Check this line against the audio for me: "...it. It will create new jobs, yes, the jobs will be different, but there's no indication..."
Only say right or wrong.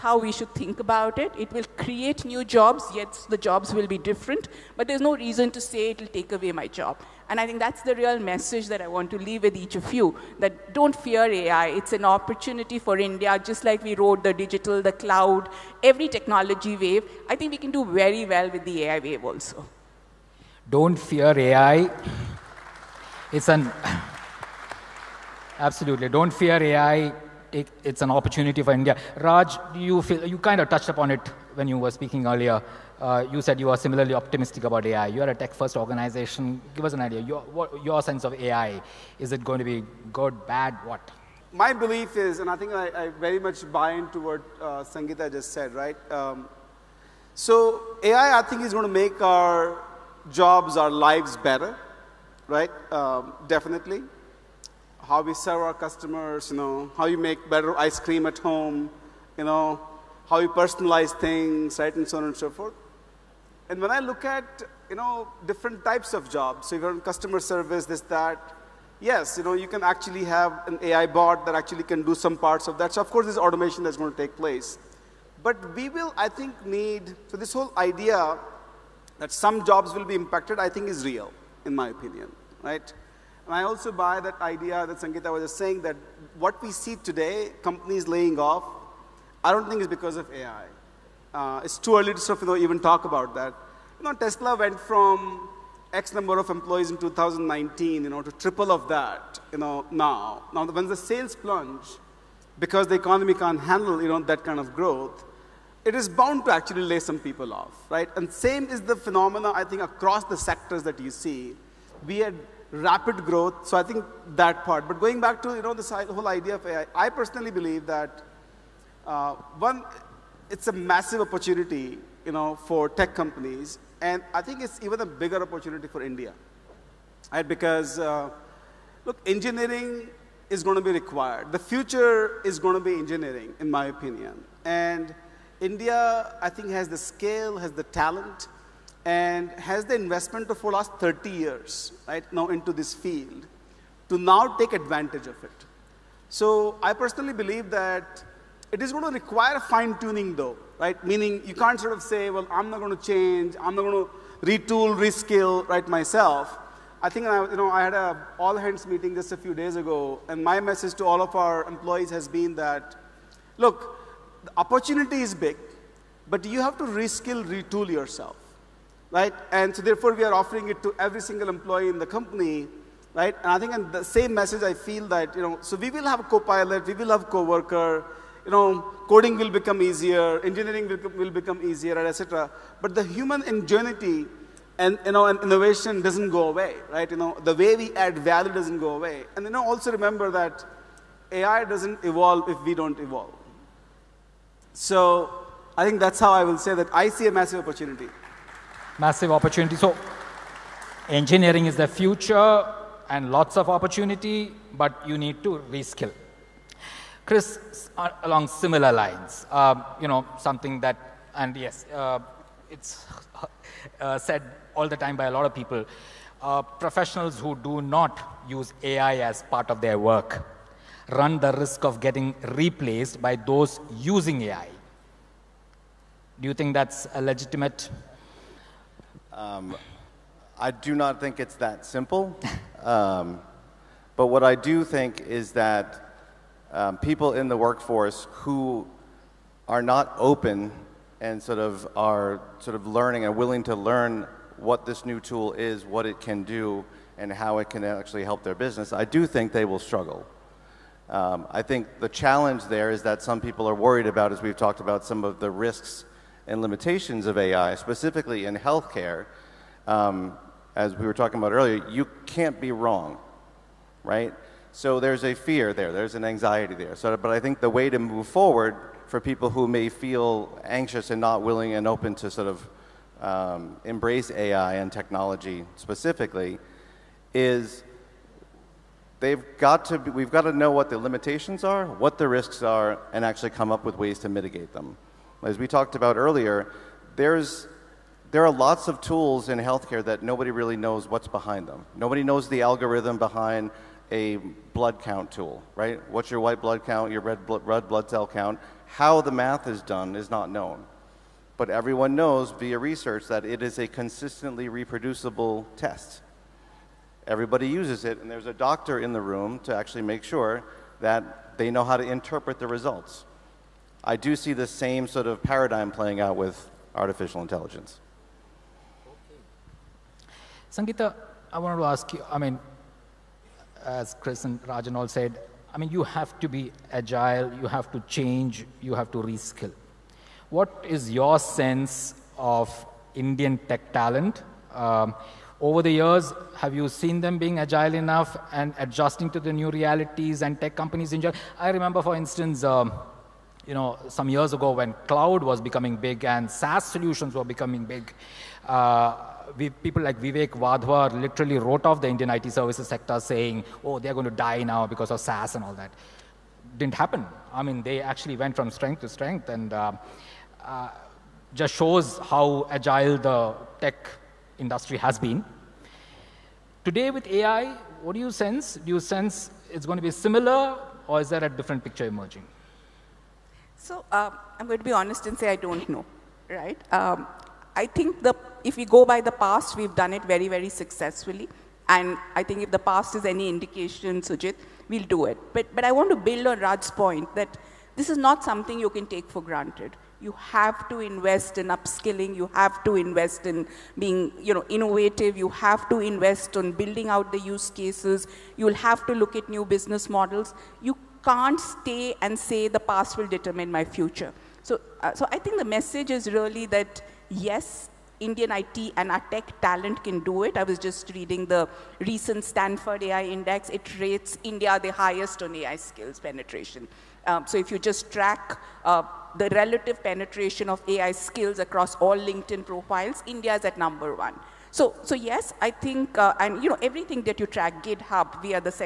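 wrong.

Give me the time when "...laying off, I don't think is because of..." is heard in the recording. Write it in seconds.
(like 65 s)
88 s.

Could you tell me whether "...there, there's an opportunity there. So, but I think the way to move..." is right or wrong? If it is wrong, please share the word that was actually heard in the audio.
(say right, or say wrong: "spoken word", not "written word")
wrong: "anxiety", not "opportunity".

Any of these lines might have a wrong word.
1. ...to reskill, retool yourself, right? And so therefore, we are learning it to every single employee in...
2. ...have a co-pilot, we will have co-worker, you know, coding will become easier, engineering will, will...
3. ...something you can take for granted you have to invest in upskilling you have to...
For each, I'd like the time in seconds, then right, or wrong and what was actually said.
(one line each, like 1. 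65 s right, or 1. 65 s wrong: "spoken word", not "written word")
1. 166 s wrong: "offering", not "learning"
2. 176 s right
3. 388 s right.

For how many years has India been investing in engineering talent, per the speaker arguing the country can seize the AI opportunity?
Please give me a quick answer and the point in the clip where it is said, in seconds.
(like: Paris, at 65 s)
30, at 140 s.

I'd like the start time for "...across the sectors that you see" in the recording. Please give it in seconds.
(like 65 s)
109 s.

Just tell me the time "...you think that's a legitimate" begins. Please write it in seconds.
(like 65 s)
226 s.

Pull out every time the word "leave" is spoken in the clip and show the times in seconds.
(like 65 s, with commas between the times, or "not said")
9 s.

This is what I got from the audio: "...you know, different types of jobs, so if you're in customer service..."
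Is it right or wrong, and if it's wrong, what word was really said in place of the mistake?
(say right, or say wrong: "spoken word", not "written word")
right.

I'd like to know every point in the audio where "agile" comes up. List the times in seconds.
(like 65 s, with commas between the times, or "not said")
326 s, 337 s, 362 s.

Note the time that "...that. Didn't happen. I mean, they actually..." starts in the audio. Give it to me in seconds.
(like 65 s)
355 s.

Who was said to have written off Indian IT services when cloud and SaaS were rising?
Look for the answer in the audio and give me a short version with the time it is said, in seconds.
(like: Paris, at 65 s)
Vivek Wadhwa, at 350 s.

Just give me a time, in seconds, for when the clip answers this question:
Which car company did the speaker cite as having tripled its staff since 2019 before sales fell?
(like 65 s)
94 s.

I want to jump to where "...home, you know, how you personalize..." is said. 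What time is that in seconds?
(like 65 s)
58 s.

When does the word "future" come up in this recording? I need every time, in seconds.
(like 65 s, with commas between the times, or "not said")
131 s, 201 s, 403 s.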